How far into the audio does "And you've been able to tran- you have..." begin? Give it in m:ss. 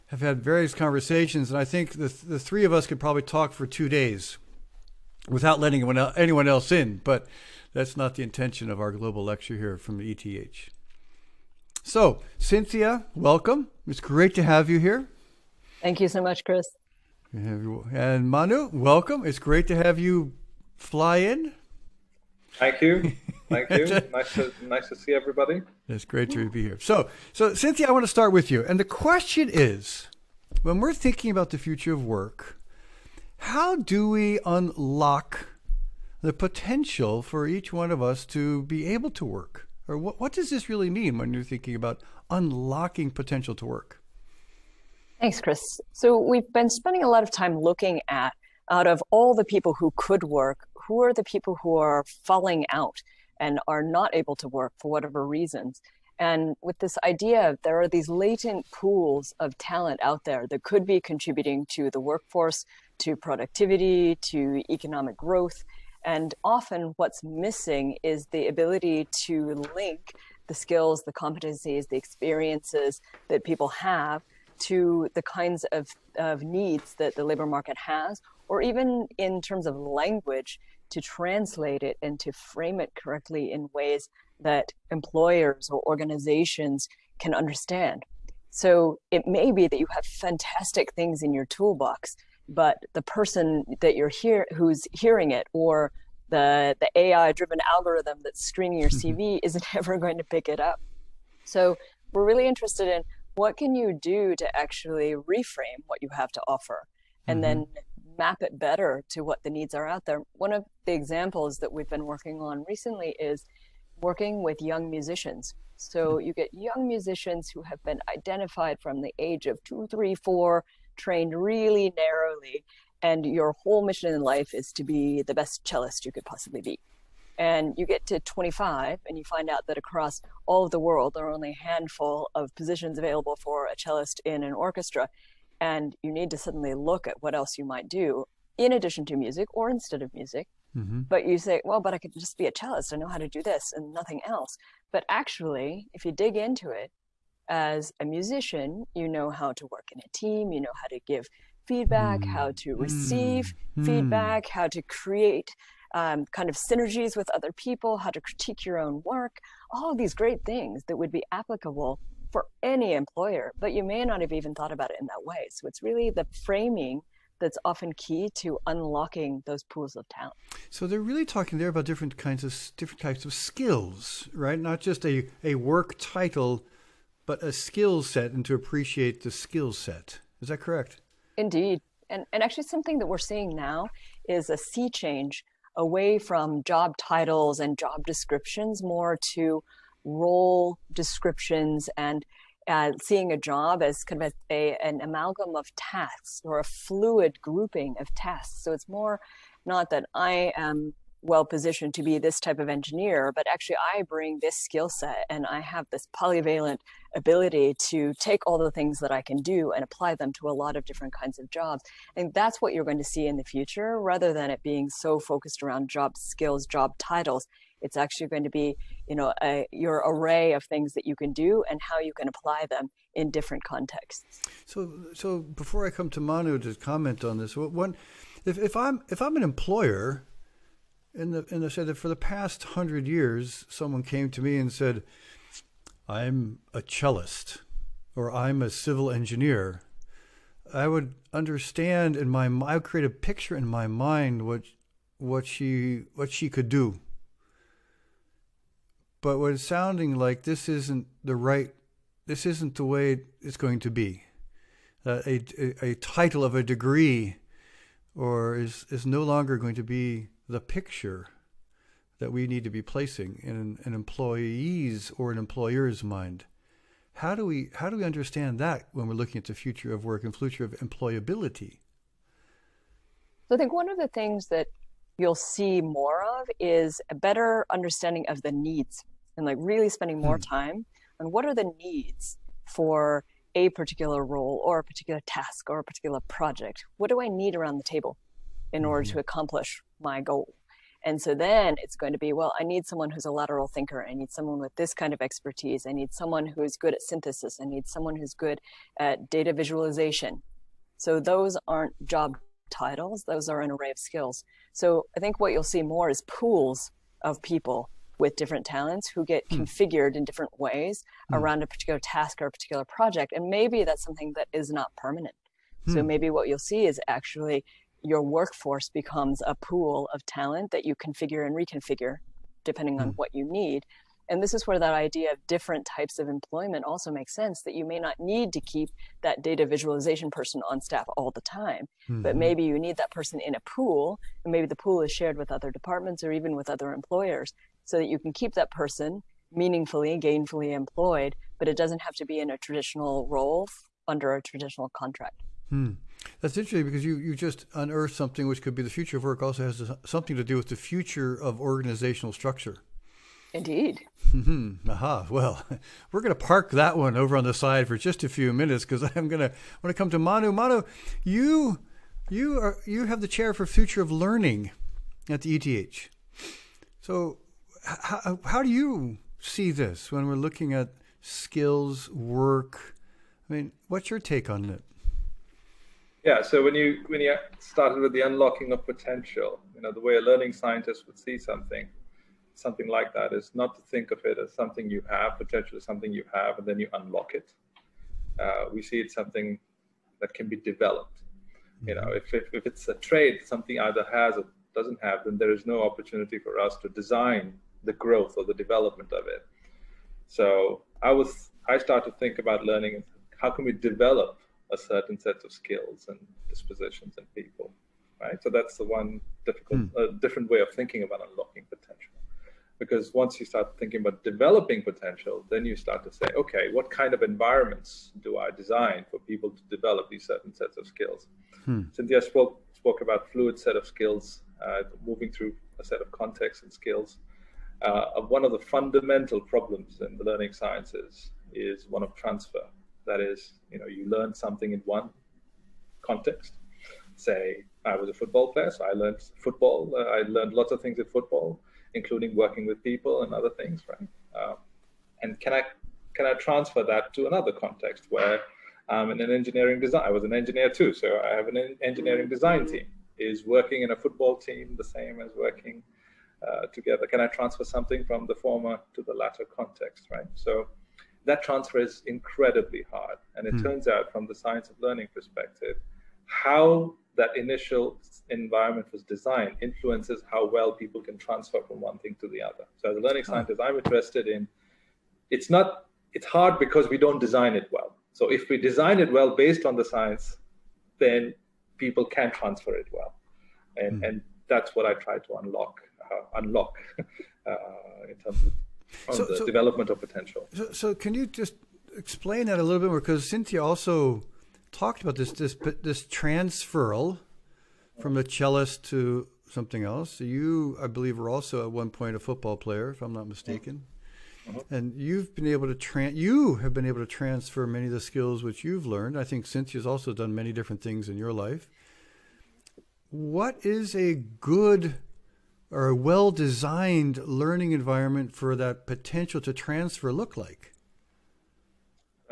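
8:24.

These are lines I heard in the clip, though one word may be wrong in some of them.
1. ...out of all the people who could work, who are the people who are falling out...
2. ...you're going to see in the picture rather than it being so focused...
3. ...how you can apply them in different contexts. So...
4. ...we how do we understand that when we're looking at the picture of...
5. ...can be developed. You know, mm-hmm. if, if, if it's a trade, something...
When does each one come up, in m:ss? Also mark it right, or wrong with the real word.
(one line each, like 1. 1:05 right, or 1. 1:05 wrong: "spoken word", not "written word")
1. 0:48 right
2. 3:32 wrong: "future", not "picture"
3. 3:41 right
4. 4:27 wrong: "future", not "picture"
5. 6:30 right.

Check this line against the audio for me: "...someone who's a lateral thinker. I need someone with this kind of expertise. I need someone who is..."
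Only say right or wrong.
right.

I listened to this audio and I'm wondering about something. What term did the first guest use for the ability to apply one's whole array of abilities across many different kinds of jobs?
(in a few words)
polyvalent.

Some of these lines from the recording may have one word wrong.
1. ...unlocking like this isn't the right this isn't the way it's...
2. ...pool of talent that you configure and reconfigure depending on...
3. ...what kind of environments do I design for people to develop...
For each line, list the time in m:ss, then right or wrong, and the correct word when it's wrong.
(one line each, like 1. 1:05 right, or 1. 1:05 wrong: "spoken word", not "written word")
1. 4:09 wrong: "sounding", not "unlocking"
2. 5:19 right
3. 6:56 right.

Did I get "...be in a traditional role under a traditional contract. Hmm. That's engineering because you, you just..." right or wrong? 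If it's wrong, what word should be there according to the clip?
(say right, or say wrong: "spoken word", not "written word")
wrong: "interesting", not "engineering".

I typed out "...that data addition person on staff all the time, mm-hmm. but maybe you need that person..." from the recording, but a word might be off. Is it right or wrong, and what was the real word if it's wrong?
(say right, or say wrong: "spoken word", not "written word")
wrong: "visualization", not "addition".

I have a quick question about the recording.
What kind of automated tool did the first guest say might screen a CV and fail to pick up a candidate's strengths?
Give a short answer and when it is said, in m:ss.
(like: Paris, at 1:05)
AI driven algorithm, at 1:36.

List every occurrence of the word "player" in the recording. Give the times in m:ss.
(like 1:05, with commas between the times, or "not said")
7:18, 8:22.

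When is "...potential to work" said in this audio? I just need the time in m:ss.
0:43.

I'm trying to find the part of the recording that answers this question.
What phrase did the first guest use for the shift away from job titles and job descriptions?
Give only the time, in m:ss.
3:04.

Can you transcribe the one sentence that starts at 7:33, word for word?
Is working in a football team the same as working uh, together?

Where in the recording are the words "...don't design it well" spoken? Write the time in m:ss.
7:56.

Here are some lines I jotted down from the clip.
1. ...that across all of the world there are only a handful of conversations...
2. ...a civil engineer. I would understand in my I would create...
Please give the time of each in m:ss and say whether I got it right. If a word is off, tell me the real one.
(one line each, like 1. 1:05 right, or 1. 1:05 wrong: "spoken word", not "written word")
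1. 2:09 wrong: "positions", not "conversations"
2. 3:58 right.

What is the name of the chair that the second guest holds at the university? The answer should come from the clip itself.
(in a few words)
future of learning.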